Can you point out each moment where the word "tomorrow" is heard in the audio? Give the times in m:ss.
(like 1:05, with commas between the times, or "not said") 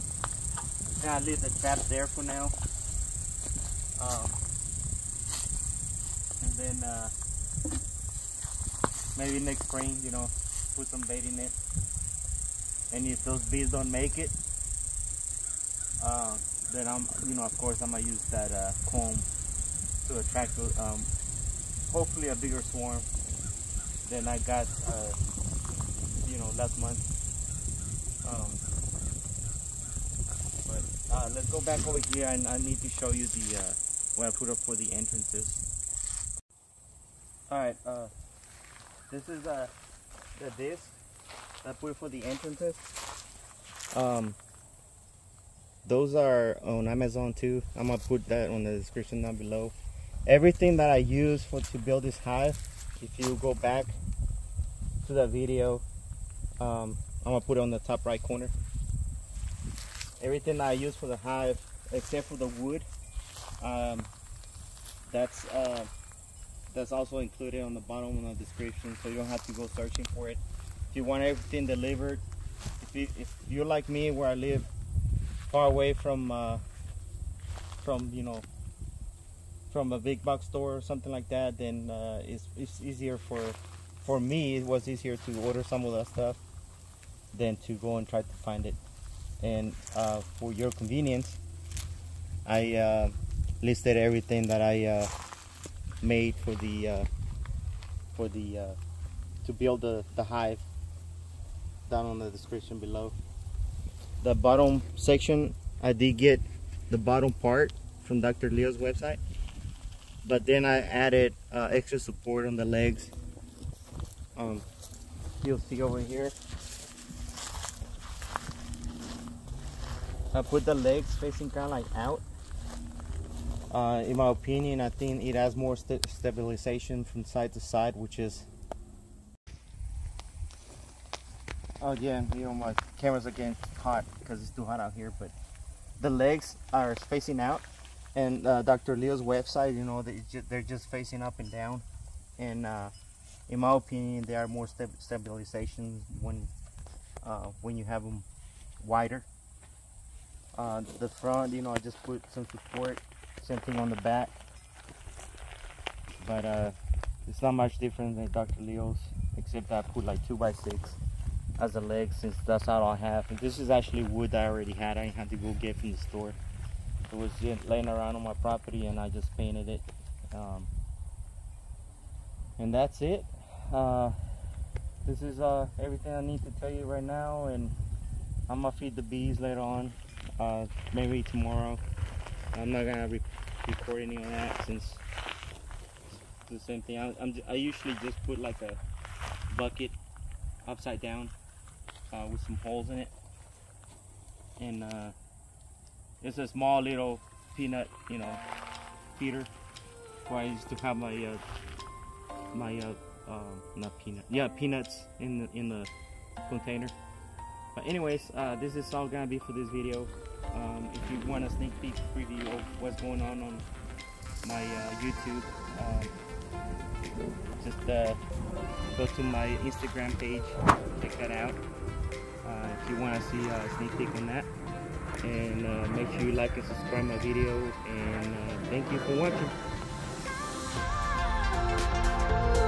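3:01.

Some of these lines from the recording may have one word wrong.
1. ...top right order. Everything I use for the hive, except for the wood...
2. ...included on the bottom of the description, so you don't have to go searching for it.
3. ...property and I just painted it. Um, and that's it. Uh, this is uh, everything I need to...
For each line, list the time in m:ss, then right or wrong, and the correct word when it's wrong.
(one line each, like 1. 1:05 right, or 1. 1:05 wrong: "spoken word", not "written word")
1. 0:57 wrong: "corner", not "order"
2. 1:07 right
3. 2:48 right.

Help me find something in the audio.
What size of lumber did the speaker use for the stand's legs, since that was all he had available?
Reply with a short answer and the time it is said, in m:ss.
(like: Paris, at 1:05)
2x6, at 2:40.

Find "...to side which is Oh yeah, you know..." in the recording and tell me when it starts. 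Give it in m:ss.
2:07.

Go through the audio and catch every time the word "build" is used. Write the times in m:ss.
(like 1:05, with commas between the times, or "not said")
0:51, 1:39.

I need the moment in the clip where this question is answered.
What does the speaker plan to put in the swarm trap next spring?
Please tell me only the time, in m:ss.
0:11.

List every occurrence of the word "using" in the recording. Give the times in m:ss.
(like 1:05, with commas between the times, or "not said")
not said.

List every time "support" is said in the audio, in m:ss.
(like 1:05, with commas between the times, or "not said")
1:51, 2:32.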